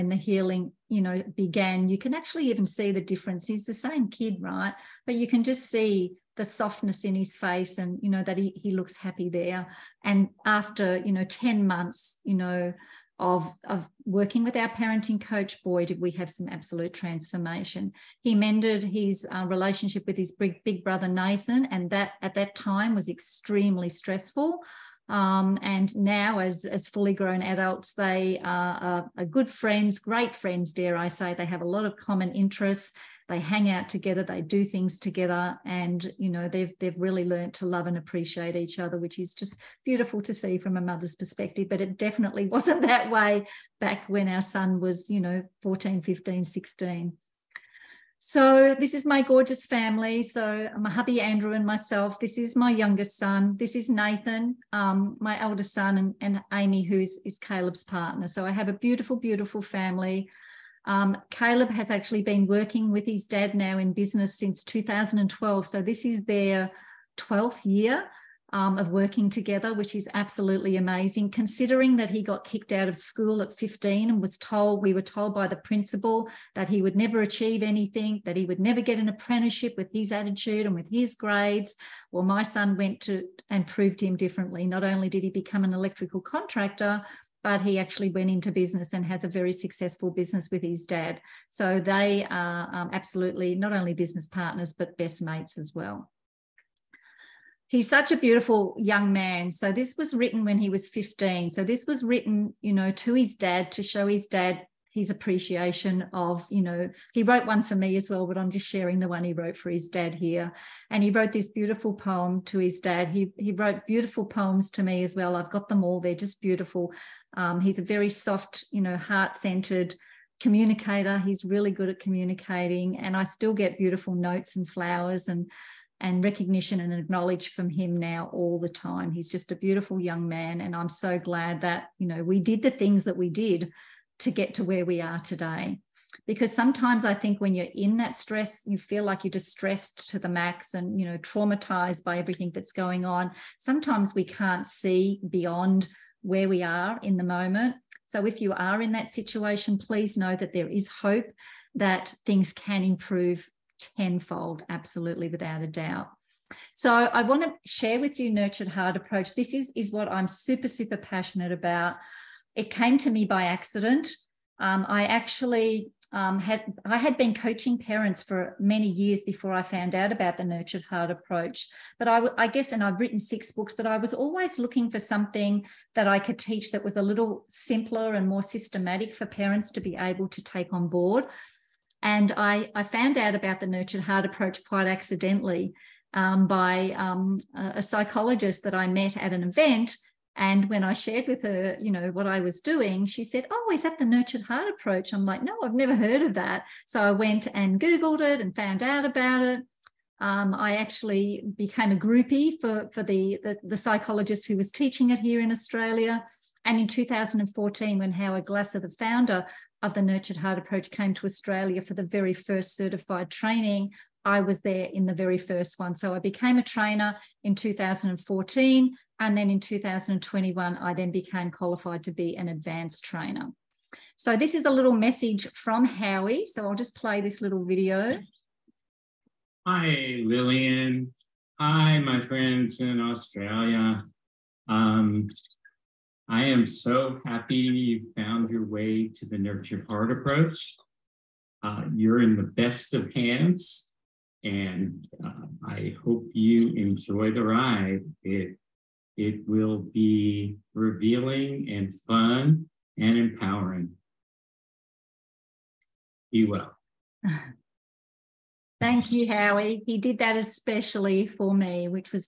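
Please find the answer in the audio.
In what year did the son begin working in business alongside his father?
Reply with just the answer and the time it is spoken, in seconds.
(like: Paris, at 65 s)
2012, at 64 s.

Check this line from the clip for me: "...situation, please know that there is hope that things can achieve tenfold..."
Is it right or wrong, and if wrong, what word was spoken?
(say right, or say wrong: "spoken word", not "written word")
wrong: "improve", not "achieve".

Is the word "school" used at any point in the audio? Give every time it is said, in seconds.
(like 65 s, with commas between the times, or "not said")
72 s.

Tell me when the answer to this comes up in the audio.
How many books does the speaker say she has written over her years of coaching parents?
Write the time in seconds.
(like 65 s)
173 s.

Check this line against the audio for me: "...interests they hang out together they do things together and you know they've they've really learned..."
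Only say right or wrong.
right.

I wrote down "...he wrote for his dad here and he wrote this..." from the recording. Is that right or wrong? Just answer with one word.
right.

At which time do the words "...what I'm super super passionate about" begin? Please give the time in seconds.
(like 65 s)
159 s.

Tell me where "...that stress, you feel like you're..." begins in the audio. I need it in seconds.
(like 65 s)
137 s.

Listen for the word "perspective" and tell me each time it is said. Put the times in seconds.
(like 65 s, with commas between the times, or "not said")
41 s.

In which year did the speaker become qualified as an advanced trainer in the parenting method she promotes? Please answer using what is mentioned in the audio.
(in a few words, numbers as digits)
2021.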